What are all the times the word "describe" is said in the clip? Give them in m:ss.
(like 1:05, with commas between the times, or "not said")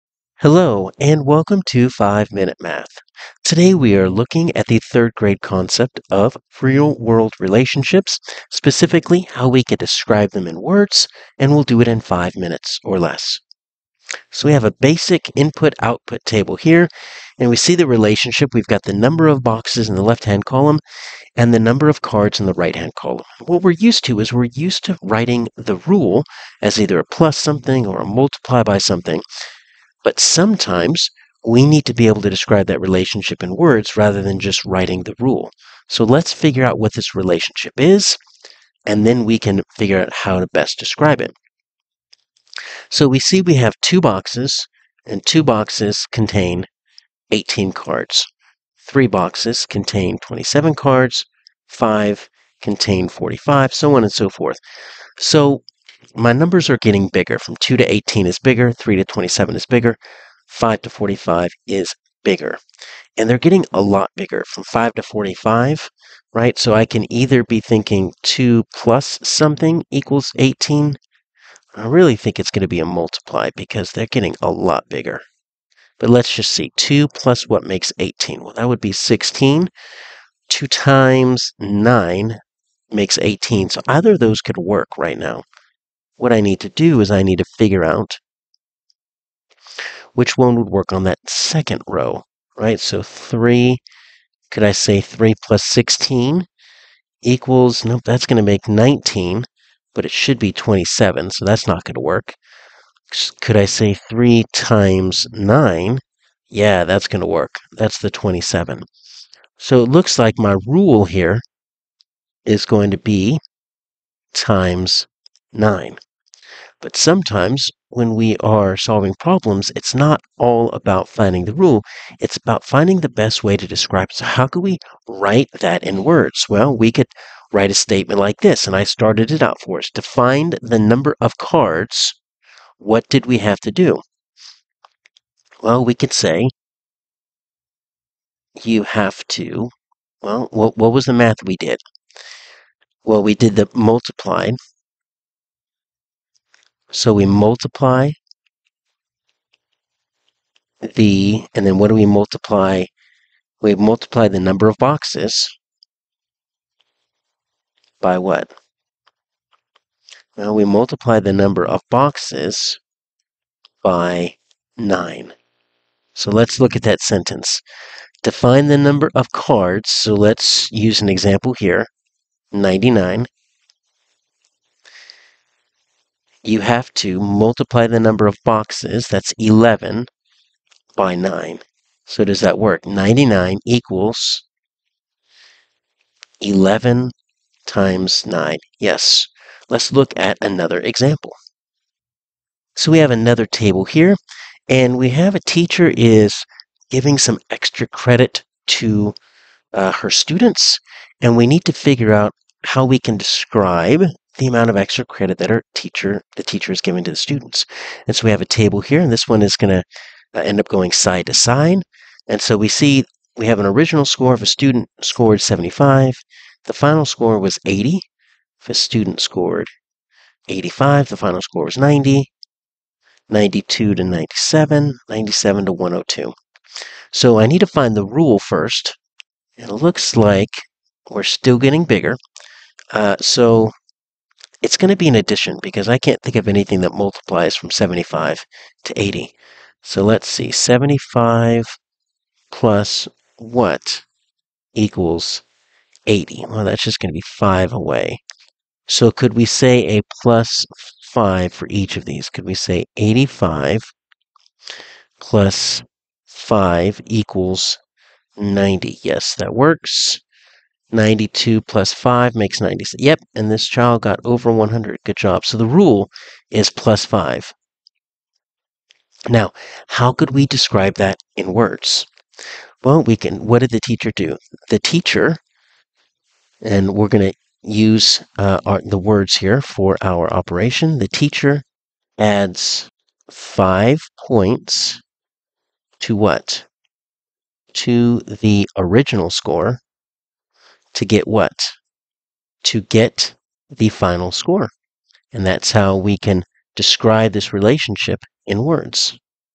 0:09, 0:32, 0:40, 2:03, 3:23, 4:30, 4:56.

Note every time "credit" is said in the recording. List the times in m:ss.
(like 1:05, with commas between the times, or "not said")
3:17, 3:25.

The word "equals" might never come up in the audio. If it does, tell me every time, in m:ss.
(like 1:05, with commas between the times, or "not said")
1:09, 1:37, 3:03, 4:04, 4:17.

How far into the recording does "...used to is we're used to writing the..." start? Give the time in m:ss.
0:23.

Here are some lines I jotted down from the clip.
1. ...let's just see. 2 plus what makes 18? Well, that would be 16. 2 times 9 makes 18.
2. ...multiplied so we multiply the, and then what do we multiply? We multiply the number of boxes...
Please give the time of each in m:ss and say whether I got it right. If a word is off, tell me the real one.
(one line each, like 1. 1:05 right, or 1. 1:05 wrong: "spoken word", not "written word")
1. 1:16 right
2. 2:23 right.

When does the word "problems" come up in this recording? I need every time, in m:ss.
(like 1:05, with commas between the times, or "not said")
1:59.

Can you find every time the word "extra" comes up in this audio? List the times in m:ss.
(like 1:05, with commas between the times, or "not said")
3:17, 3:24.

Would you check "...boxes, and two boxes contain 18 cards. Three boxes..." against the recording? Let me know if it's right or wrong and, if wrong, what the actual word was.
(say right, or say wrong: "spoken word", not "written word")
right.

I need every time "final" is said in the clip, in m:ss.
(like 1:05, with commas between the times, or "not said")
3:36, 3:41, 4:53.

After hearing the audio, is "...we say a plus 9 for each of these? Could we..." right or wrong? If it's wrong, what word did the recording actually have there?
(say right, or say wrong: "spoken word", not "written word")
wrong: "5", not "9".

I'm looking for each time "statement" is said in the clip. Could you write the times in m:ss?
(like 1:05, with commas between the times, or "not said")
2:07.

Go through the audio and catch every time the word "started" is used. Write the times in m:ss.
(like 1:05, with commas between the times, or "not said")
2:08.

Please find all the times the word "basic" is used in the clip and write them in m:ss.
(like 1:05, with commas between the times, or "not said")
0:14.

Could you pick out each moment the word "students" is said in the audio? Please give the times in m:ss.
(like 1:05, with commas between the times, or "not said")
3:20, 3:27, 3:34, 3:38.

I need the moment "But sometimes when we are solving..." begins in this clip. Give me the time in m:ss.
1:56.